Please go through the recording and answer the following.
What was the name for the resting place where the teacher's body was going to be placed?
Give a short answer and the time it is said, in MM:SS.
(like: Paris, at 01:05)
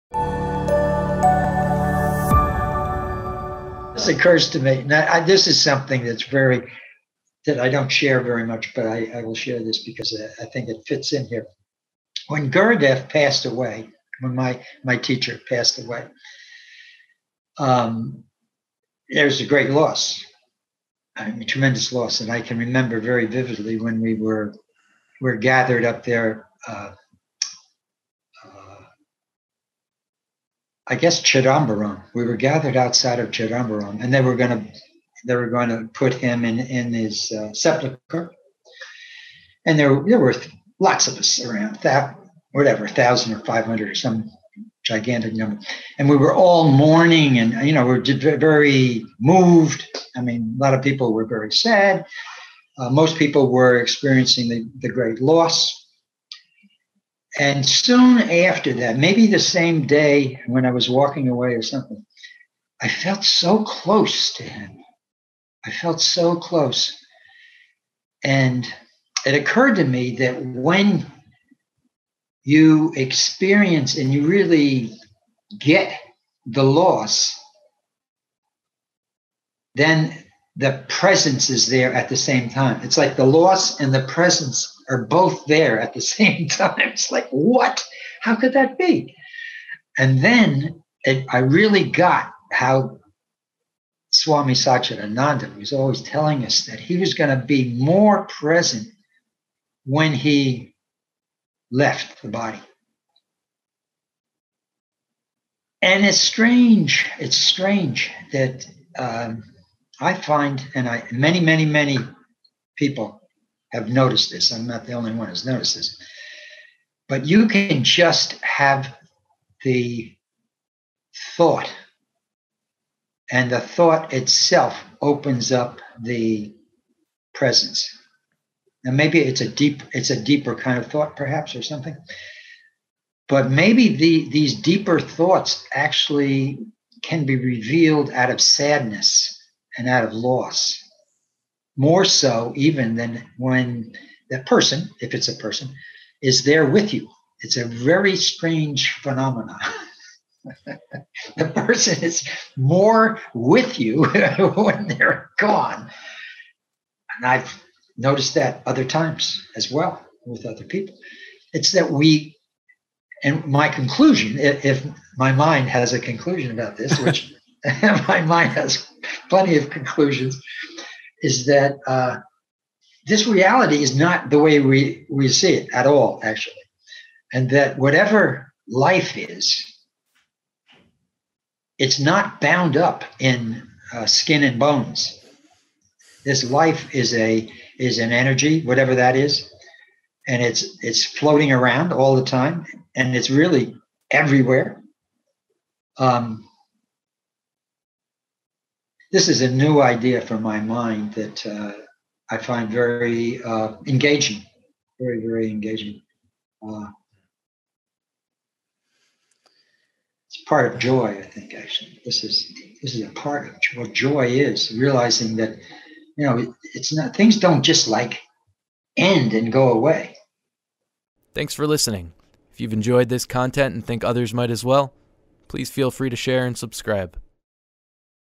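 sepulcher, at 00:37.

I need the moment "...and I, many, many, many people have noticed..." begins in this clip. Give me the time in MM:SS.
01:50.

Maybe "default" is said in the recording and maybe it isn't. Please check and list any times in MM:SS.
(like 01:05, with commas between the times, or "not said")
not said.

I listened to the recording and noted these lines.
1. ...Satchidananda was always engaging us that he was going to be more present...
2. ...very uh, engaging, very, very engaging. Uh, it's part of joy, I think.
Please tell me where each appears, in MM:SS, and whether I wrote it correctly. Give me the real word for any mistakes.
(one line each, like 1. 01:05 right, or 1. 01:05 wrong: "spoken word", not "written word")
1. 01:34 wrong: "telling", not "engaging"
2. 03:22 right.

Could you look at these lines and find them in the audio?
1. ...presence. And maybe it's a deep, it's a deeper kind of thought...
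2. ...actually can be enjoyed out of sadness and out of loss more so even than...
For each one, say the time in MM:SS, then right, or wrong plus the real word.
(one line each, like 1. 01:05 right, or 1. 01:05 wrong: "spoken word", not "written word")
1. 02:07 right
2. 02:15 wrong: "revealed", not "enjoyed".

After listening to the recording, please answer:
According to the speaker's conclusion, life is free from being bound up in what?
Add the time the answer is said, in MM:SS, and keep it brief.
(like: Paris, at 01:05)
skin and bones, at 03:04.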